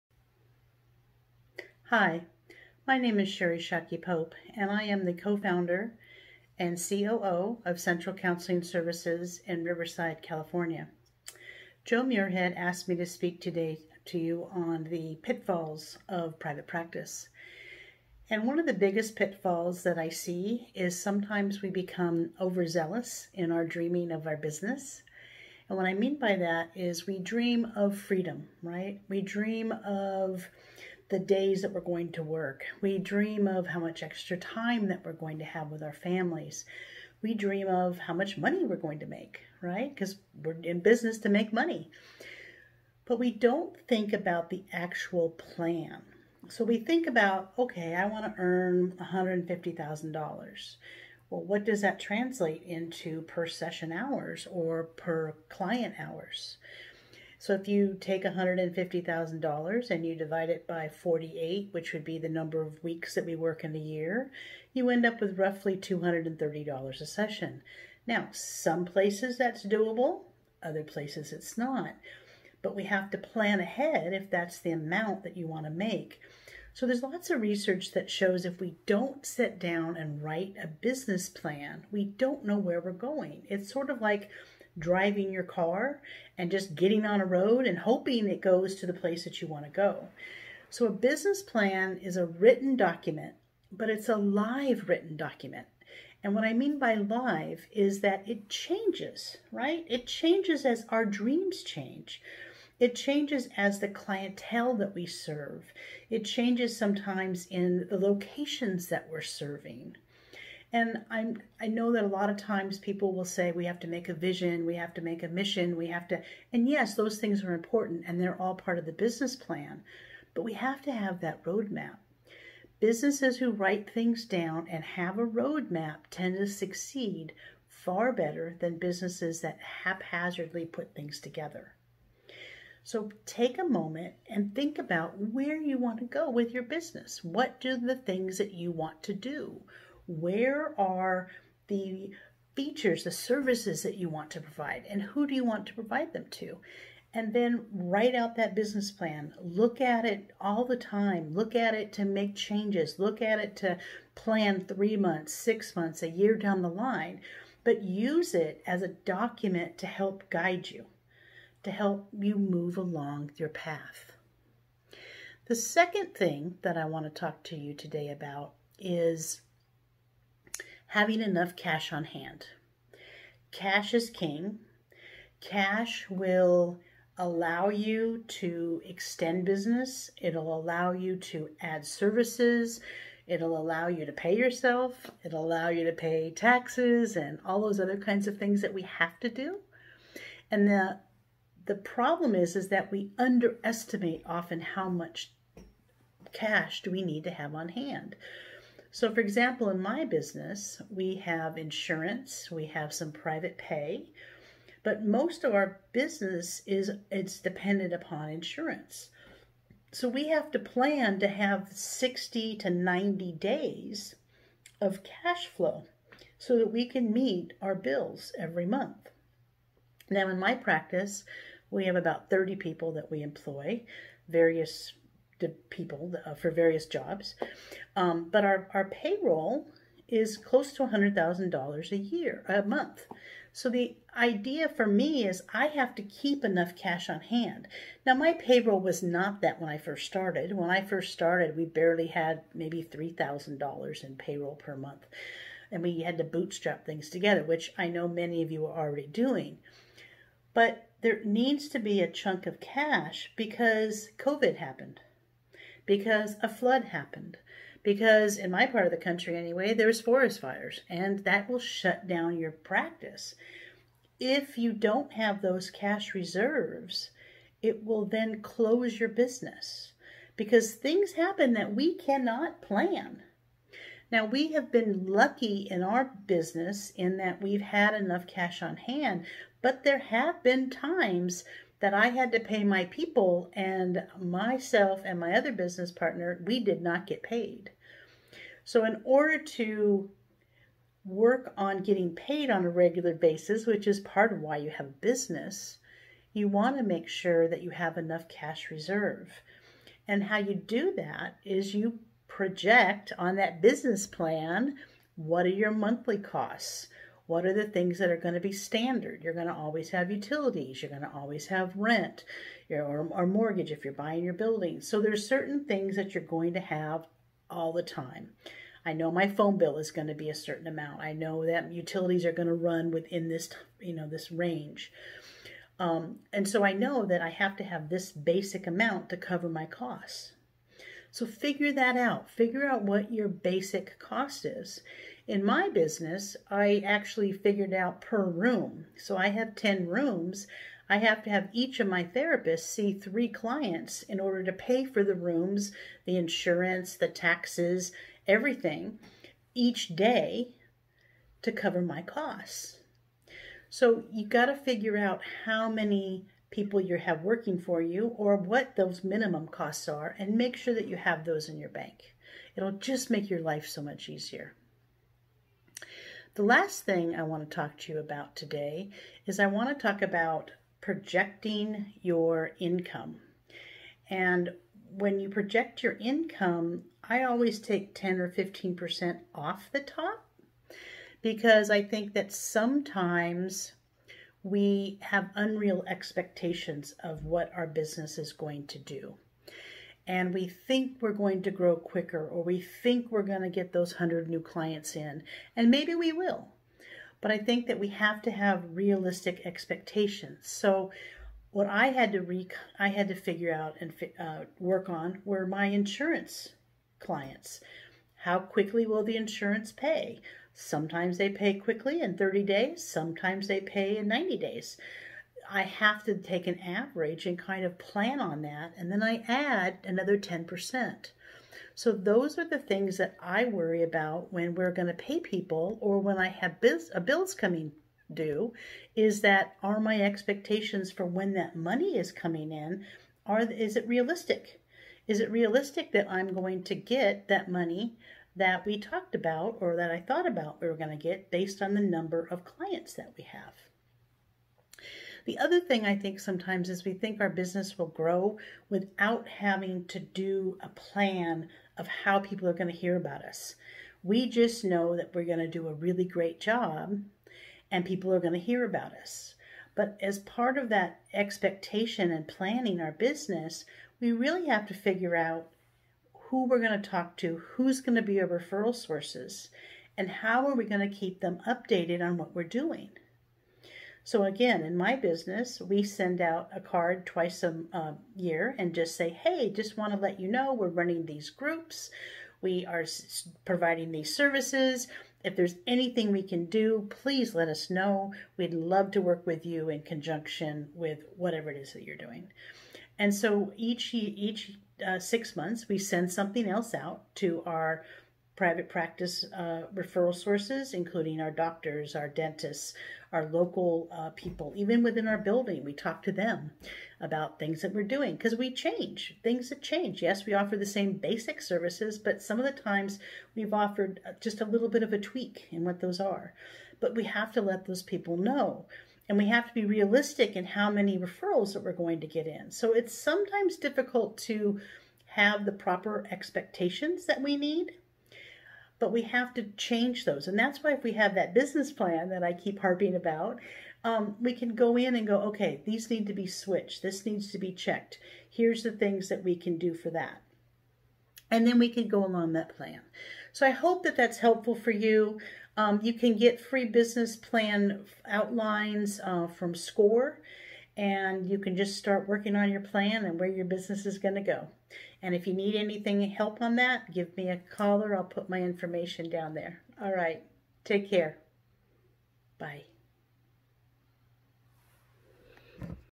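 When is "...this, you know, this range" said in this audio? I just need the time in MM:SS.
05:23.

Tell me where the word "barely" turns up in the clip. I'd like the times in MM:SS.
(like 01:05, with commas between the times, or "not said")
04:01.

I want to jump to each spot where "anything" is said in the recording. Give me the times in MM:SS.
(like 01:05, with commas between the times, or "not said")
08:05, 09:15.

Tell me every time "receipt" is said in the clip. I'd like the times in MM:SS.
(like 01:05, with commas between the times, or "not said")
not said.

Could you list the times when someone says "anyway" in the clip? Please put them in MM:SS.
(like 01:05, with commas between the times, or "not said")
04:19.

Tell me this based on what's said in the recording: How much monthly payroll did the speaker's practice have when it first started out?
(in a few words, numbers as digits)
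$3,000.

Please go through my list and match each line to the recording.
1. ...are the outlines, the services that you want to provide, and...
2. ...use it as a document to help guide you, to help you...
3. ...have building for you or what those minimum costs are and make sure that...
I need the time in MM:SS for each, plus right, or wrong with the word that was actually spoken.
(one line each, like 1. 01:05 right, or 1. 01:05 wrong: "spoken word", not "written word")
1. 02:20 wrong: "features", not "outlines"
2. 02:37 right
3. 05:56 wrong: "working", not "building".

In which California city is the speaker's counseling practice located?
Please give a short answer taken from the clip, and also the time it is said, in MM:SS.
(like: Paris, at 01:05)
Riverside, at 00:09.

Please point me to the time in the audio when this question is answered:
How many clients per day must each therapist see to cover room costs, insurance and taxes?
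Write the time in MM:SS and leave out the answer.
05:42.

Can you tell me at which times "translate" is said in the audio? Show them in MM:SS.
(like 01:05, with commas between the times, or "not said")
00:51.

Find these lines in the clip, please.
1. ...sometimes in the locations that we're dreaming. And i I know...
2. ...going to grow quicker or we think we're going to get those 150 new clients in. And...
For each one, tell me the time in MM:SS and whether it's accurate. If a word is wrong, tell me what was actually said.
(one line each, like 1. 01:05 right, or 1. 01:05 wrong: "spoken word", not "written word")
1. 01:46 wrong: "serving", not "dreaming"
2. 06:31 wrong: "100", not "150".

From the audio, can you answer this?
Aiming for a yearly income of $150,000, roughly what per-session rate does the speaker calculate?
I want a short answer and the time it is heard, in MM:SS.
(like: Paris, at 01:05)
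$230, at 01:05.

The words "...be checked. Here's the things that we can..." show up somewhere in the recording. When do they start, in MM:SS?
08:57.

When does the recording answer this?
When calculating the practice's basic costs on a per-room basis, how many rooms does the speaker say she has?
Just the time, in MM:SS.
05:39.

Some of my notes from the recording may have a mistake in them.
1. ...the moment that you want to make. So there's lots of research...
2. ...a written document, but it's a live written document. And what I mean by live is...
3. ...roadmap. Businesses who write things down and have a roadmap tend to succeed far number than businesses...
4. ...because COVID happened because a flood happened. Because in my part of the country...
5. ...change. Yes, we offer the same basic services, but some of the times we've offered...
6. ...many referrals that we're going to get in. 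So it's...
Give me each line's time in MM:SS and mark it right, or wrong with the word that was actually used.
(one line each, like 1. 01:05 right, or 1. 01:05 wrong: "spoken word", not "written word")
1. 01:14 wrong: "amount", not "moment"
2. 01:32 right
3. 02:01 wrong: "better", not "number"
4. 04:13 right
5. 08:29 right
6. 08:40 right.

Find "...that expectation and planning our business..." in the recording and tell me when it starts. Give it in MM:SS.
07:40.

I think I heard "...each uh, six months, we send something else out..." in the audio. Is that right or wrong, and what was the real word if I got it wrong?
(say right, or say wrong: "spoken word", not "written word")
right.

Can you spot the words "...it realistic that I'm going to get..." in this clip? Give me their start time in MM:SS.
07:15.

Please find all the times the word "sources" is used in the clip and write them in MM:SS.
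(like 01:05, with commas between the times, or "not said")
07:48, 08:20.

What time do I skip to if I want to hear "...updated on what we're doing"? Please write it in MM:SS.
07:51.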